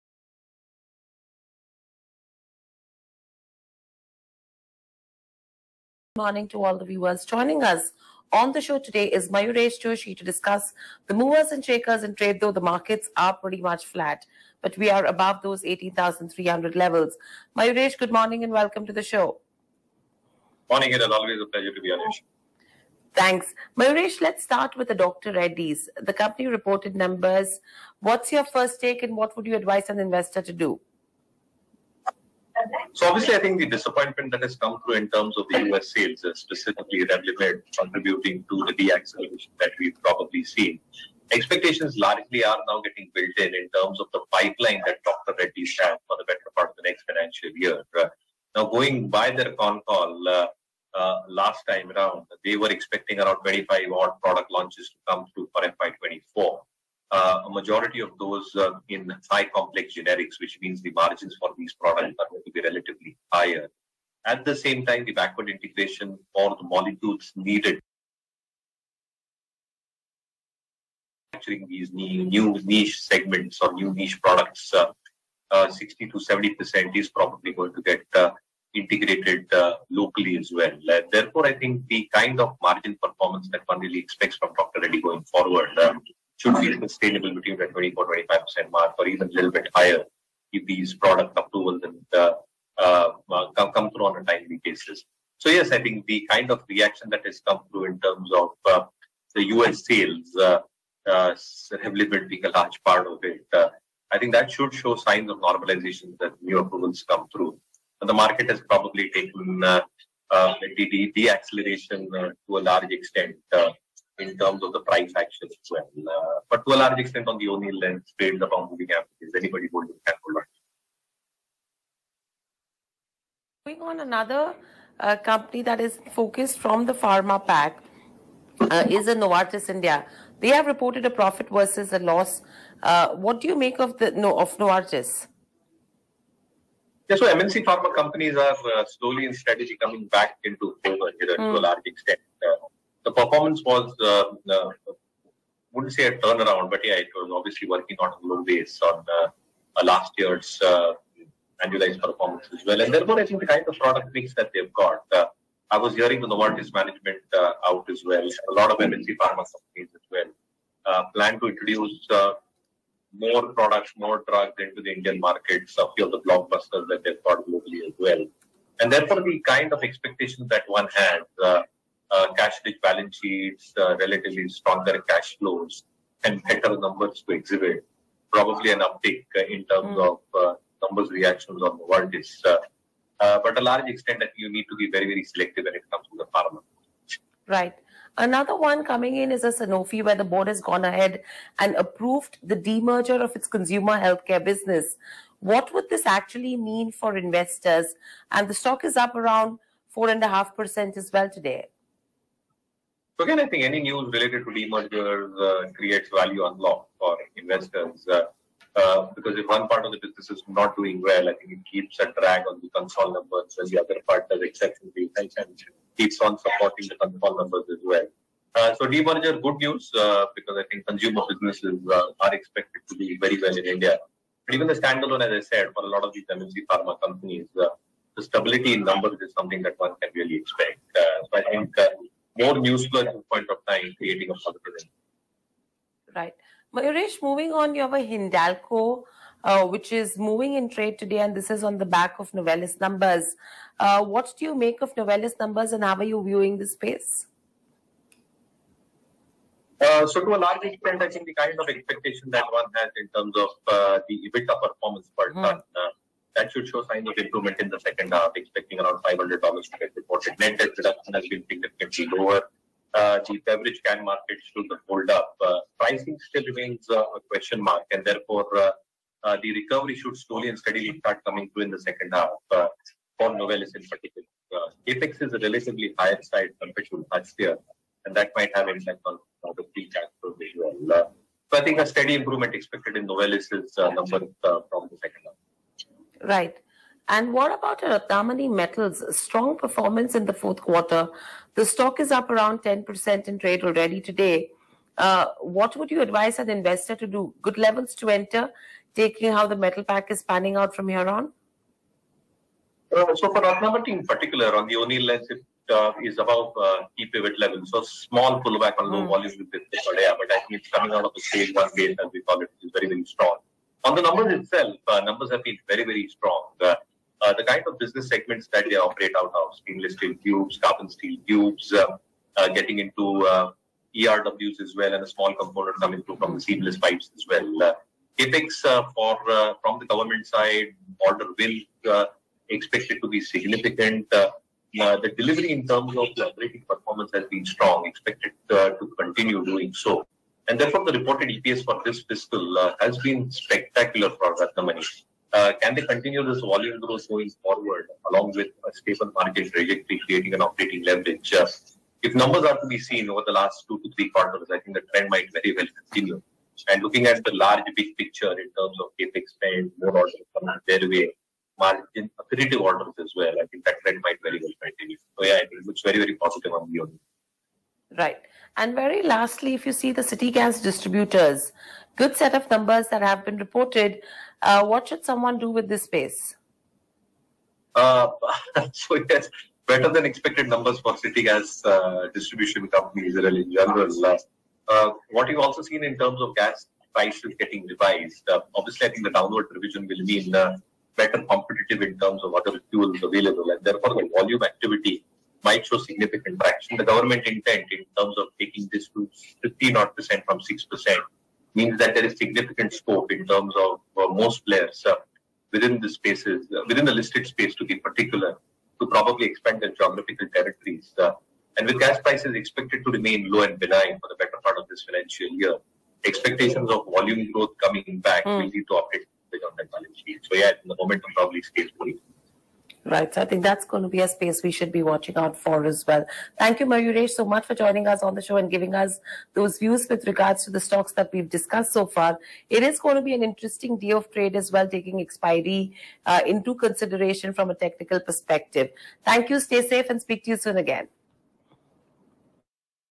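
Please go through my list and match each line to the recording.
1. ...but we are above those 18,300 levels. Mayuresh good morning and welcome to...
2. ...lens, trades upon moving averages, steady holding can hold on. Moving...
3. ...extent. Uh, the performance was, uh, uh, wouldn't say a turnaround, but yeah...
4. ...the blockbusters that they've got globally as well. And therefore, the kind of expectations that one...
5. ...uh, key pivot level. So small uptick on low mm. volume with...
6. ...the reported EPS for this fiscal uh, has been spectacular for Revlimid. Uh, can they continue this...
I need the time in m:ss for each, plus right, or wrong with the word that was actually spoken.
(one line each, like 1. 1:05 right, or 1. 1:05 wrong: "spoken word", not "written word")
1. 0:14 right
2. 1:57 wrong: "anybody", not "steady"
3. 2:21 right
4. 2:46 right
5. 5:06 wrong: "pullback", not "uptick"
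6. 5:40 wrong: "Ratnamani", not "Revlimid".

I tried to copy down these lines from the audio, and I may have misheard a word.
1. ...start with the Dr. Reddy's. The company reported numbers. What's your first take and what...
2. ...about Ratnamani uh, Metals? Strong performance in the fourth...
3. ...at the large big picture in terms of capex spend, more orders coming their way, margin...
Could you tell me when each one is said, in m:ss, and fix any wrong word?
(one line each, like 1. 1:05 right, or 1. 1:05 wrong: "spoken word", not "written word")
1. 0:24 right
2. 4:47 right
3. 5:57 right.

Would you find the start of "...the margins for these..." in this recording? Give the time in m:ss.
1:00.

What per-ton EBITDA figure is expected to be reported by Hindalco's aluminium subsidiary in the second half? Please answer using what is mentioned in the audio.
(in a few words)
$500.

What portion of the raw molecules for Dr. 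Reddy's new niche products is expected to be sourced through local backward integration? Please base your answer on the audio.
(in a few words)
60 to 70 percent.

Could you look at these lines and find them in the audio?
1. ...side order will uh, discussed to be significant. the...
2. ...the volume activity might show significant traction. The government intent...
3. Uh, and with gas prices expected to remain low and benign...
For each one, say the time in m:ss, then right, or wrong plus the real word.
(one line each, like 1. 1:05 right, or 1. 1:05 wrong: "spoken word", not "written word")
1. 5:30 wrong: "expected", not "discussed"
2. 6:33 right
3. 6:50 right.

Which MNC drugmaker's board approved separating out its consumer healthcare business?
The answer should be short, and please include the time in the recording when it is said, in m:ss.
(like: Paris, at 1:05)
Sanofi, at 3:09.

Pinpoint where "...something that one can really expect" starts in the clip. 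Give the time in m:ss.
3:49.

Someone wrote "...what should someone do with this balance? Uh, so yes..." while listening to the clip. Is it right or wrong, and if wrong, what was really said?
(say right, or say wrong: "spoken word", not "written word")
wrong: "space", not "balance".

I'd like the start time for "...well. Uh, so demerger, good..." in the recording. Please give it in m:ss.
3:37.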